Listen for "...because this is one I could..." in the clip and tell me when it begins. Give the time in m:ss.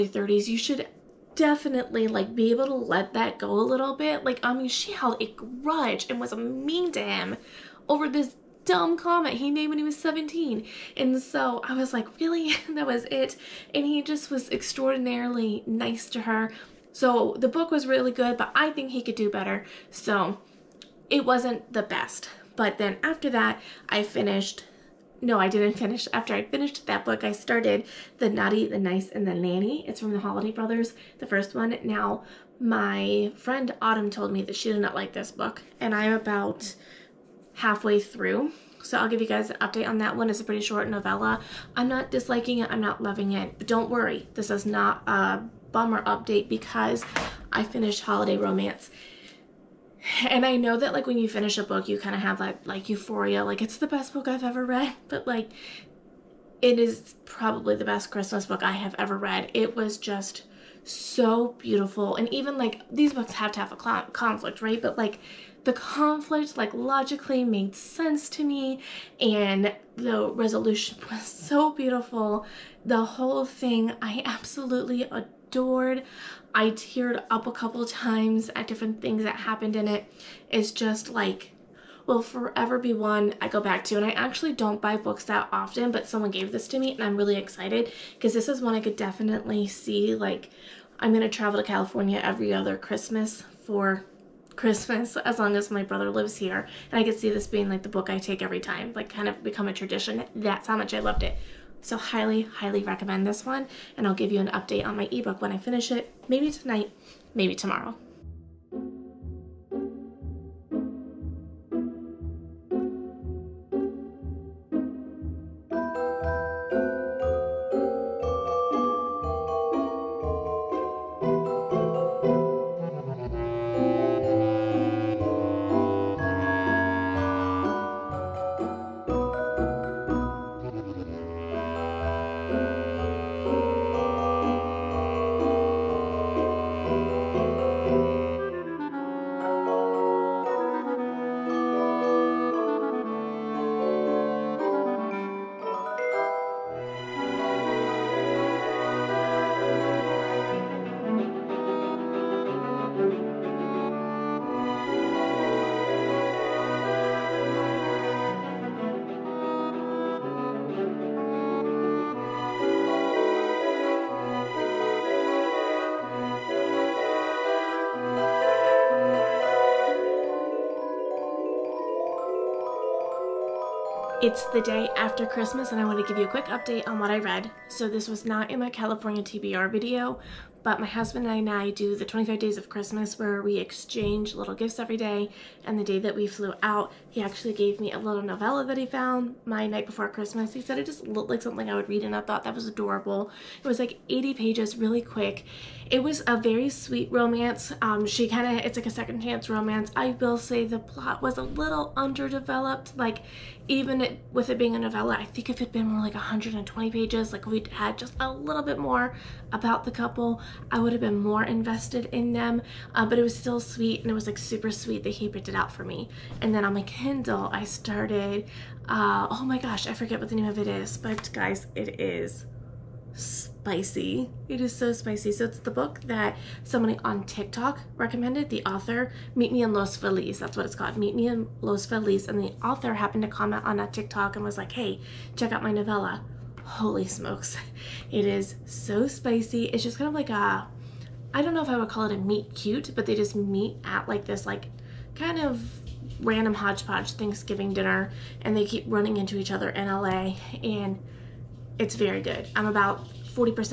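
1:28.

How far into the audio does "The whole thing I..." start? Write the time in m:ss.
1:12.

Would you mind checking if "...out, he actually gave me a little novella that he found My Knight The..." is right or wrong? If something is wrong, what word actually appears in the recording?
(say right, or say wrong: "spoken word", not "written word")
wrong: "Before", not "The".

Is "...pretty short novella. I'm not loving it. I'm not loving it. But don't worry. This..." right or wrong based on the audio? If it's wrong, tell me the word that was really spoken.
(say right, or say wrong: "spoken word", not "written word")
wrong: "disliking", not "loving".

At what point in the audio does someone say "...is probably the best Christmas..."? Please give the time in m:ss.
0:56.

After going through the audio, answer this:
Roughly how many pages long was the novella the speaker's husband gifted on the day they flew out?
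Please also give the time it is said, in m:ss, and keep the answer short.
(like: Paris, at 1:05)
80, at 3:14.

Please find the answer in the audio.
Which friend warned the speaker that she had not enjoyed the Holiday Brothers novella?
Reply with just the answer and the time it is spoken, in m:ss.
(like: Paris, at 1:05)
Autumn, at 0:33.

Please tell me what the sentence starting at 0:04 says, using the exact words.
Like, I mean, she held a grudge and was mean to him over this dumb comment he made when he was 17.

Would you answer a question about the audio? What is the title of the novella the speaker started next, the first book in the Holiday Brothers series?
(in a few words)
The Naughty, the Nice, and the Nanny.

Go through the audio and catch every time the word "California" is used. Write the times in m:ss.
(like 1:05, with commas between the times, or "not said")
1:31, 2:58.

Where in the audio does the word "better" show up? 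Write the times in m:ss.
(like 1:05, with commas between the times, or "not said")
0:19.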